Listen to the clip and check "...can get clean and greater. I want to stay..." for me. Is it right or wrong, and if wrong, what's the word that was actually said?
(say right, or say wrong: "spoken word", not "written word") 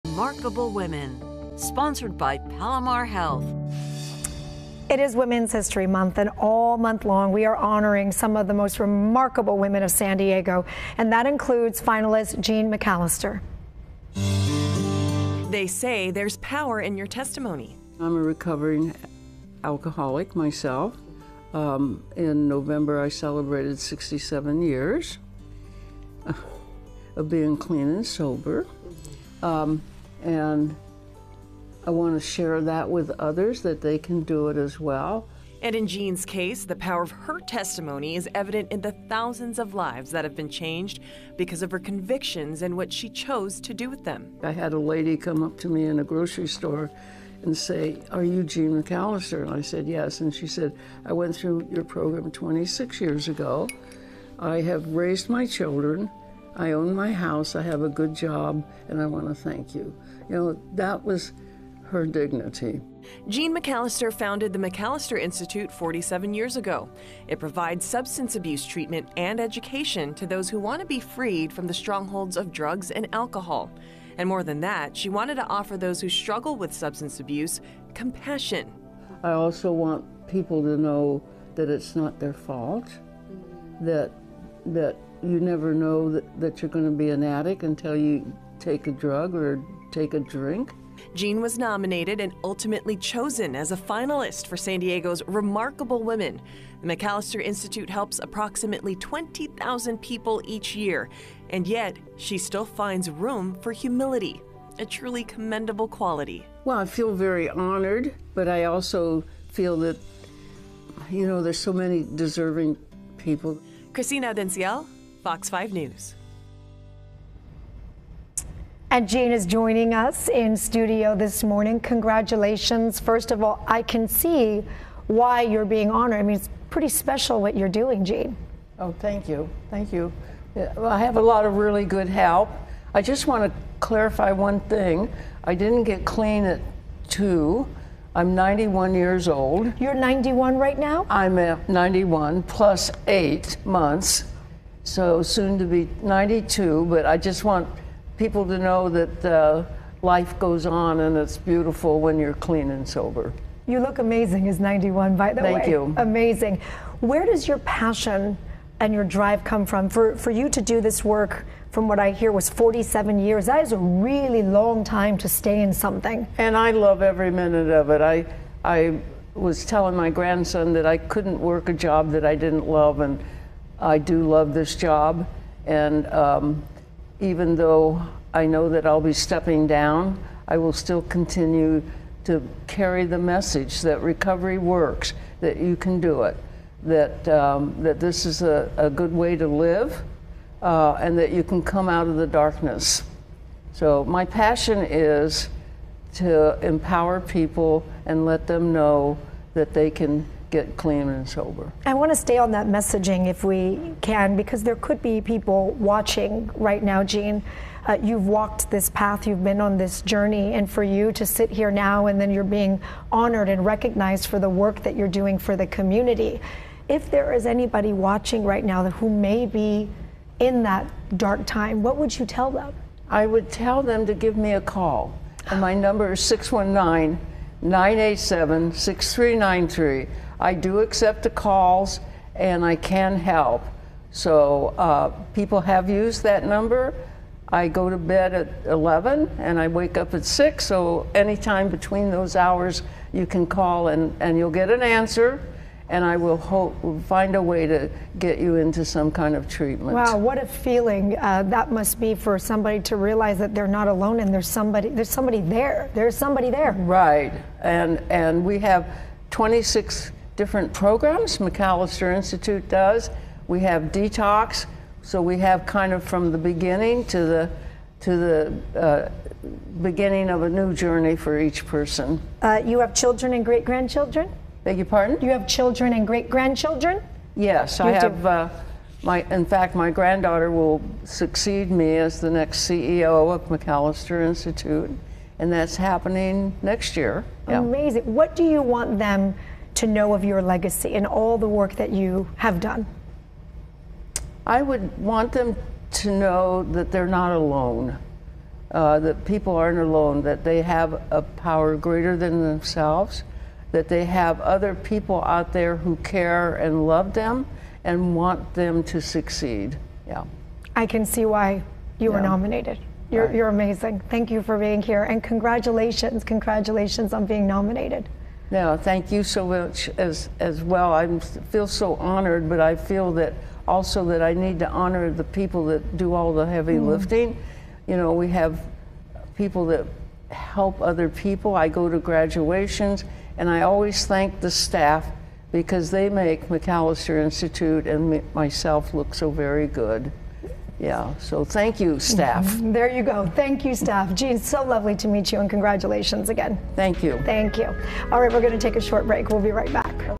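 wrong: "sober", not "greater".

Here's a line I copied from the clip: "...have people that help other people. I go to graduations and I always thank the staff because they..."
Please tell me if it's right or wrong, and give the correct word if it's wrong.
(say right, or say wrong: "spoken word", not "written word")
right.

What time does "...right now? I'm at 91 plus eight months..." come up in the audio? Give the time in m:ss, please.
2:20.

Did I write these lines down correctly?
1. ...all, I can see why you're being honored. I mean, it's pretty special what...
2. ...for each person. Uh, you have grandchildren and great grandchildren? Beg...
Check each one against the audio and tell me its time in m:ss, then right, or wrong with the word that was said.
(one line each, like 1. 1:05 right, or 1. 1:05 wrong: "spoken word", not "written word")
1. 2:03 right
2. 4:31 wrong: "children", not "grandchildren".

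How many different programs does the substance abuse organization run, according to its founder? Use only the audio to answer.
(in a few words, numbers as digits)
26.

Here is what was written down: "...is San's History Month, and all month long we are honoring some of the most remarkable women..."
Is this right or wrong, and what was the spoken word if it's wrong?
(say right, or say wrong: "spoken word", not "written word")
wrong: "Women", not "San".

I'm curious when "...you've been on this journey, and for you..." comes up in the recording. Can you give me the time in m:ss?
3:29.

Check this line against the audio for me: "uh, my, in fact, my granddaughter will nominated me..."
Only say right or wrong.
wrong.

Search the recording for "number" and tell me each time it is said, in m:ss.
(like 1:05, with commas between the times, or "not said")
3:45, 3:56.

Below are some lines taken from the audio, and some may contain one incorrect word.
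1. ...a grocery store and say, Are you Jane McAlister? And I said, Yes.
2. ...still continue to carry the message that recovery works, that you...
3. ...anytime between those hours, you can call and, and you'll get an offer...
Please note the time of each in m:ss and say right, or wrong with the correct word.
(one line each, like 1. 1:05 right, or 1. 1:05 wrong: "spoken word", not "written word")
1. 0:45 wrong: "Jeanne", not "Jane"
2. 3:00 right
3. 4:01 wrong: "answer", not "offer".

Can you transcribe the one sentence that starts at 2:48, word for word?
I, I was telling my grandson that I couldn't work a job that I didn't love.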